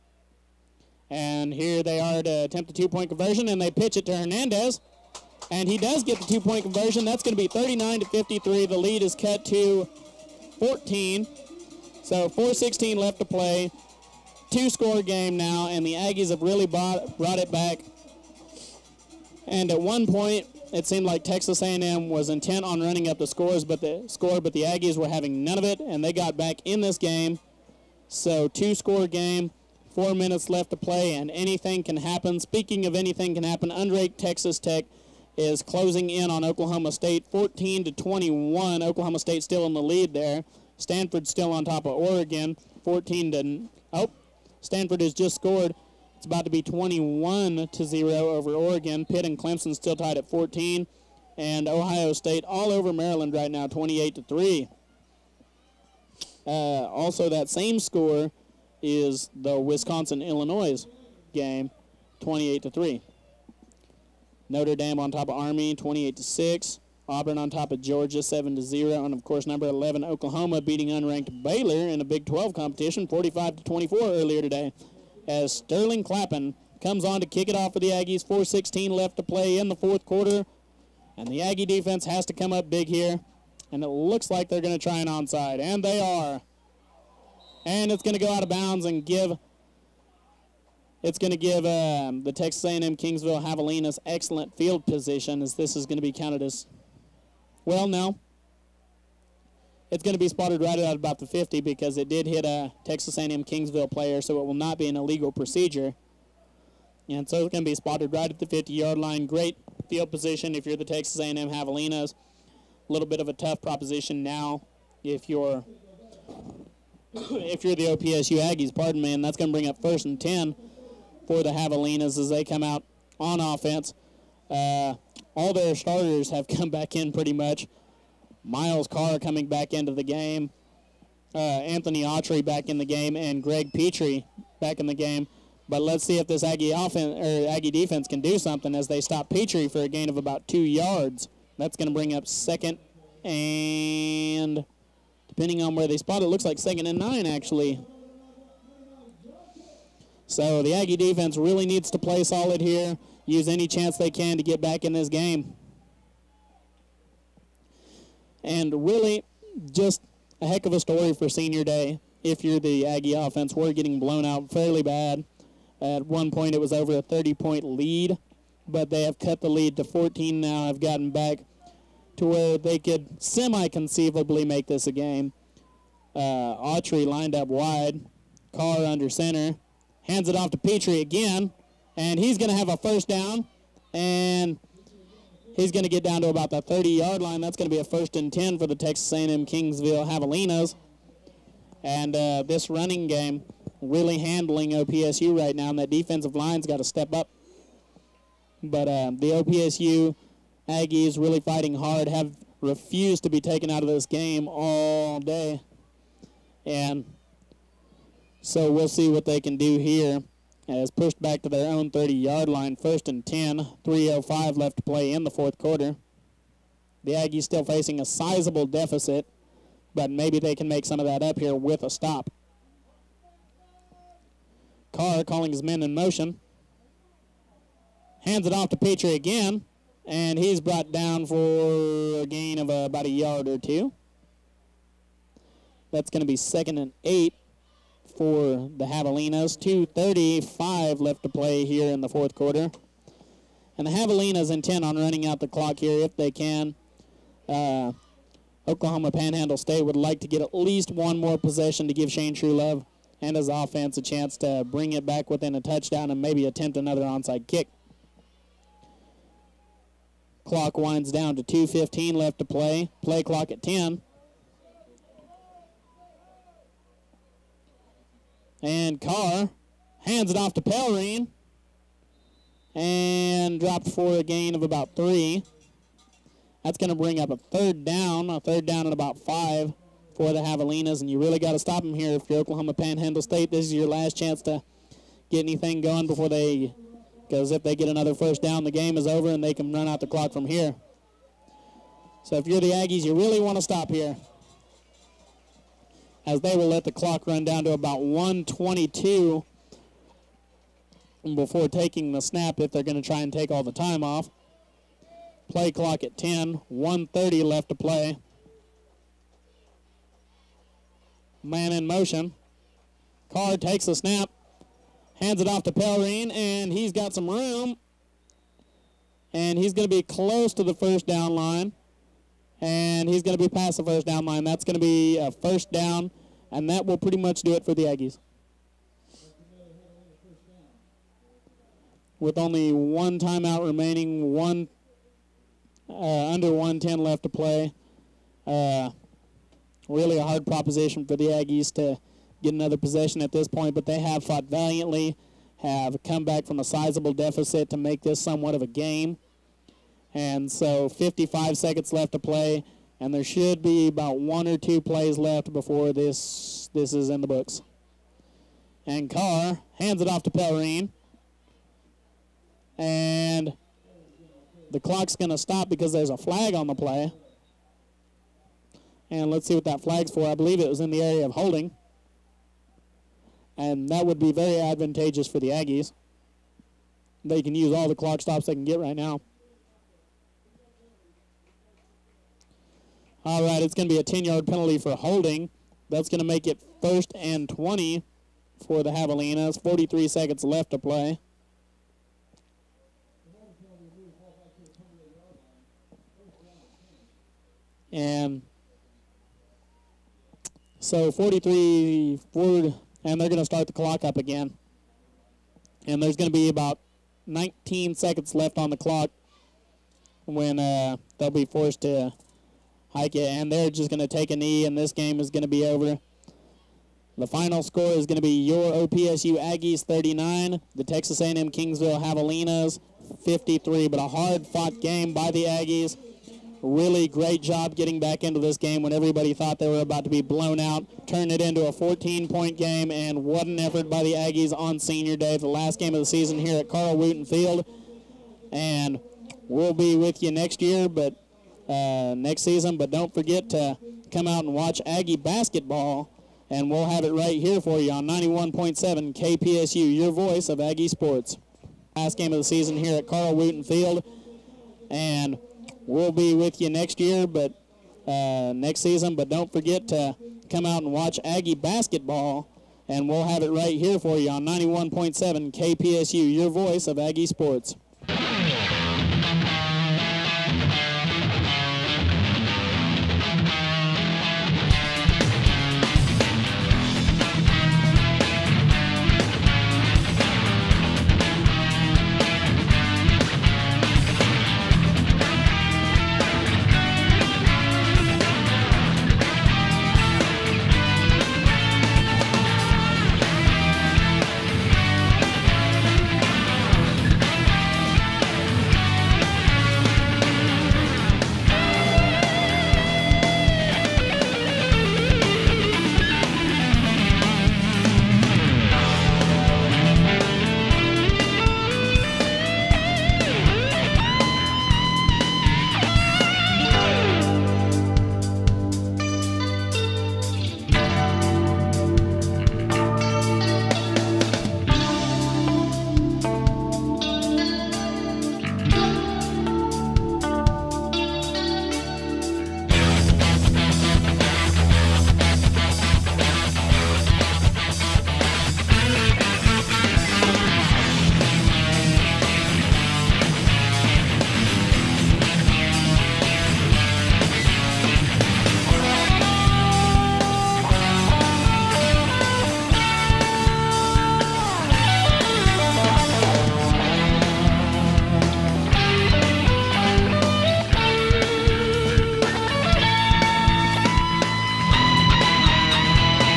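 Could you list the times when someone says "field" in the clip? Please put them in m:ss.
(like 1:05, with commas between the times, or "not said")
1:34, 1:49, 7:17, 7:33.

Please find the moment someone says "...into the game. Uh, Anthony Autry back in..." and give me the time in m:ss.
2:09.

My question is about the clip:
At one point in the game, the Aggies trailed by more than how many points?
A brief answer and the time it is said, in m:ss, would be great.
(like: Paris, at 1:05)
30, at 2:46.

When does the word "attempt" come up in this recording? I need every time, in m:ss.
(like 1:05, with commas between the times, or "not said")
0:02, 4:16.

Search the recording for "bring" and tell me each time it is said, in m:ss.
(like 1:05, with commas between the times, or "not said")
1:59, 2:21, 4:14, 4:36.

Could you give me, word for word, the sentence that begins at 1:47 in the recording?
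And so it's going to be spotted right at the 50-yard line.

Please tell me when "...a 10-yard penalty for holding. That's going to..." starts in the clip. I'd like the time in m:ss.
6:23.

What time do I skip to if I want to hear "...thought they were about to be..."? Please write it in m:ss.
7:09.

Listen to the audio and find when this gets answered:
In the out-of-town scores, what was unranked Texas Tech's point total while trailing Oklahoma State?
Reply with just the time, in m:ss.
0:37.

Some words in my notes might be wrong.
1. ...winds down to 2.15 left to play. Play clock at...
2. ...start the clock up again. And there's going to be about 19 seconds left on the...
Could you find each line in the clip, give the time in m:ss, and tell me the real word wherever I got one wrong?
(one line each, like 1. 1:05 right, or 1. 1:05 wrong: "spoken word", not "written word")
1. 4:20 right
2. 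6:43 right.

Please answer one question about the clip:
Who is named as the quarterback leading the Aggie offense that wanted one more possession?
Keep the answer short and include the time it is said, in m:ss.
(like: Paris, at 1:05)
Shane Truelove, at 4:12.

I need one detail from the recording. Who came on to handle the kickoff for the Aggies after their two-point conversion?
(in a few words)
Sterling Clappin.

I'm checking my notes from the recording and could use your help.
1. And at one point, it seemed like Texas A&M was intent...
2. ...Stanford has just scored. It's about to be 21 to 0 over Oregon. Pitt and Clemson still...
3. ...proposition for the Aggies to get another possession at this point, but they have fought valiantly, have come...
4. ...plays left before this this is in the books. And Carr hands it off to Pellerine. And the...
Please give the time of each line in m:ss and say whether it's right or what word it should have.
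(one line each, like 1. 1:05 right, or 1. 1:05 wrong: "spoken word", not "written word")
1. 0:19 right
2. 0:44 right
3. 5:40 right
4. 5:54 right.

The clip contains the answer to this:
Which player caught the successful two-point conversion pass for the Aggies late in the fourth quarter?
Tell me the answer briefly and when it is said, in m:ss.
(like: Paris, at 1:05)
Hernandez, at 0:04.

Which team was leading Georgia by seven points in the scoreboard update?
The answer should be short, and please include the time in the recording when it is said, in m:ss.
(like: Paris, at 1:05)
Auburn, at 1:07.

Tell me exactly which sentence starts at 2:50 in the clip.
Have gotten back to where they could semi conceivably make this a game.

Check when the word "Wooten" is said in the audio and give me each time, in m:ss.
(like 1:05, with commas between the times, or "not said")
7:16, 7:33.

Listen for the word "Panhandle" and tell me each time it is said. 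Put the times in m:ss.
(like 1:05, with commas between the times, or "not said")
4:09, 4:42.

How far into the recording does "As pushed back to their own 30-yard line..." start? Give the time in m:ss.
3:30.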